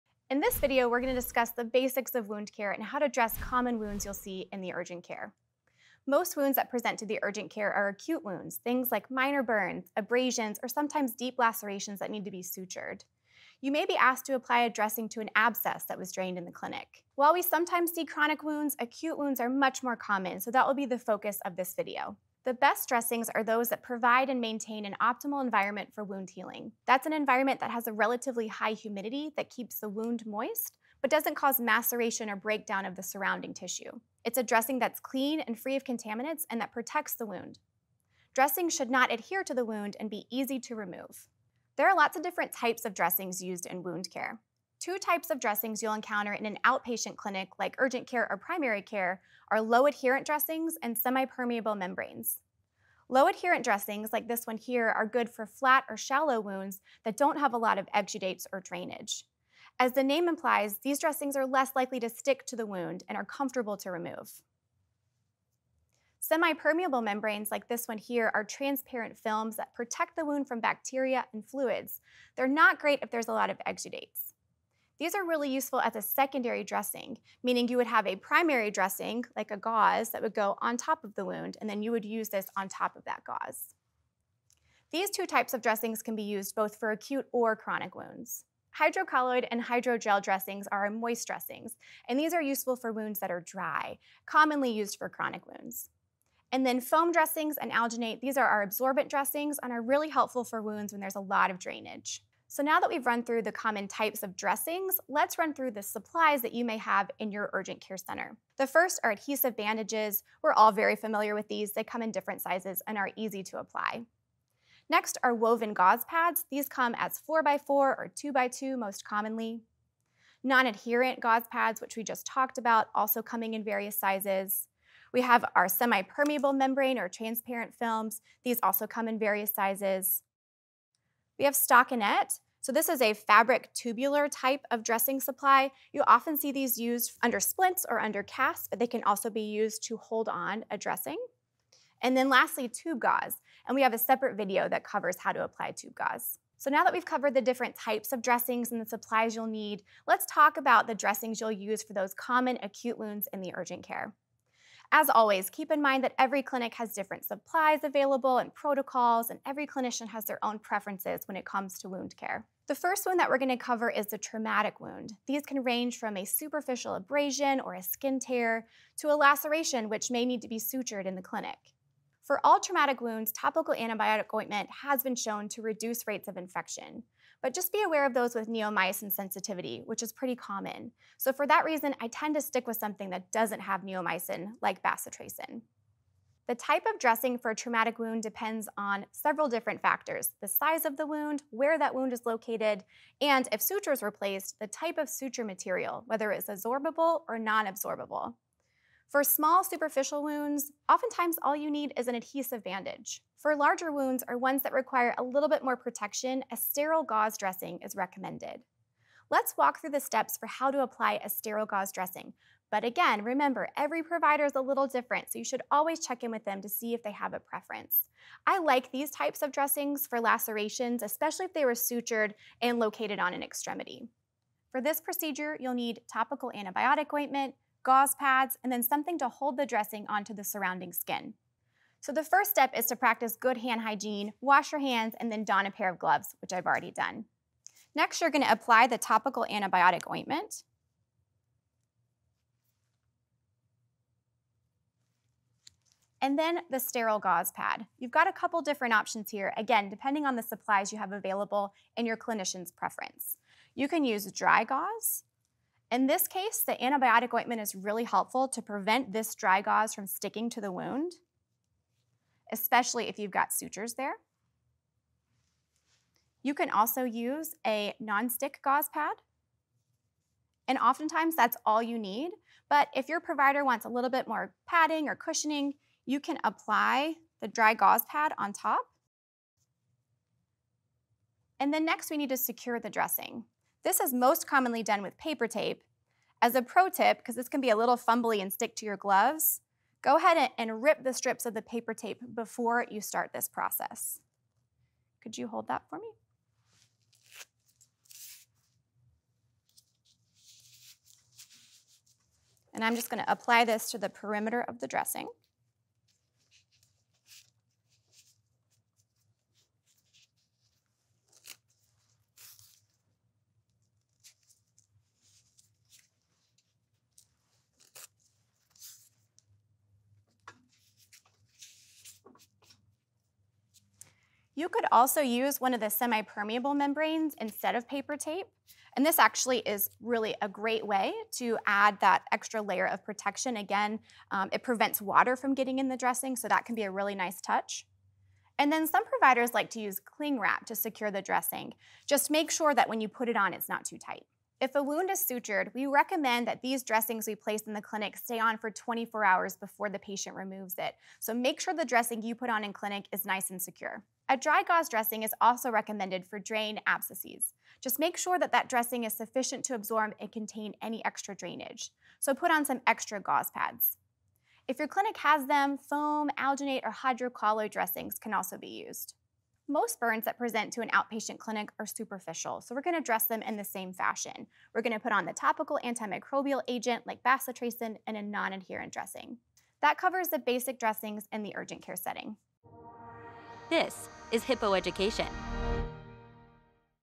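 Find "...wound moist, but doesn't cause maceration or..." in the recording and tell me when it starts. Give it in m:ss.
0:29.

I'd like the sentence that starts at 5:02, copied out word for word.
And I'm just gonna apply this to the perimeter of the dressing.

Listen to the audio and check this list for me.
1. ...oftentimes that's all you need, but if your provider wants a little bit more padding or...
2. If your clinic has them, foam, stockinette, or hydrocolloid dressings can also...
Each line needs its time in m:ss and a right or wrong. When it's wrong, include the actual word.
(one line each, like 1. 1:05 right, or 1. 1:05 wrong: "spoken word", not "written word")
1. 4:30 right
2. 6:04 wrong: "alginate", not "stockinette".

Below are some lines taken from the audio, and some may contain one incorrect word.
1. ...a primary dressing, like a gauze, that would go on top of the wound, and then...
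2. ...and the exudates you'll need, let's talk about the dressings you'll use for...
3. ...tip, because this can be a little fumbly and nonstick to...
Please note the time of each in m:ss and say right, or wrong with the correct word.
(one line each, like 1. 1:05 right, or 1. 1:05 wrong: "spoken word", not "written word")
1. 1:18 right
2. 2:28 wrong: "supplies", not "exudates"
3. 4:46 wrong: "stick", not "nonstick".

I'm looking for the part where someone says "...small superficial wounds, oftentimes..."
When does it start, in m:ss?
3:19.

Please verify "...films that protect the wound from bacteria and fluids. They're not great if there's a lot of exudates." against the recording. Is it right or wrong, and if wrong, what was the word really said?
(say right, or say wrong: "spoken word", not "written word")
right.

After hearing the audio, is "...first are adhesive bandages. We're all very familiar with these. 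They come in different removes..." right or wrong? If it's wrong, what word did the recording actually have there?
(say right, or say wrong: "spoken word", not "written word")
wrong: "sizes", not "removes".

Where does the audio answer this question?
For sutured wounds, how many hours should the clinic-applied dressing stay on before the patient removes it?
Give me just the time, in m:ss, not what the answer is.
5:48.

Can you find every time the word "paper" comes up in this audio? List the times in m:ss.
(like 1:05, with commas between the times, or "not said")
4:45, 4:51, 5:27.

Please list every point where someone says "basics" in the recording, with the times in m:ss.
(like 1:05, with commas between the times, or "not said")
0:01, 6:20.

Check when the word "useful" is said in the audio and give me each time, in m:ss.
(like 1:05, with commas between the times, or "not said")
1:15, 1:32.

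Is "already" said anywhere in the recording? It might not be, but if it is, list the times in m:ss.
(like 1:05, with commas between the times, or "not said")
3:56.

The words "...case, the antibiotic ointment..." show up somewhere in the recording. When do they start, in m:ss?
4:16.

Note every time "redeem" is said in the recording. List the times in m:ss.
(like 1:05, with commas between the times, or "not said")
not said.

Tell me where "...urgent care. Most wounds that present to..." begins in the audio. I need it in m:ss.
0:04.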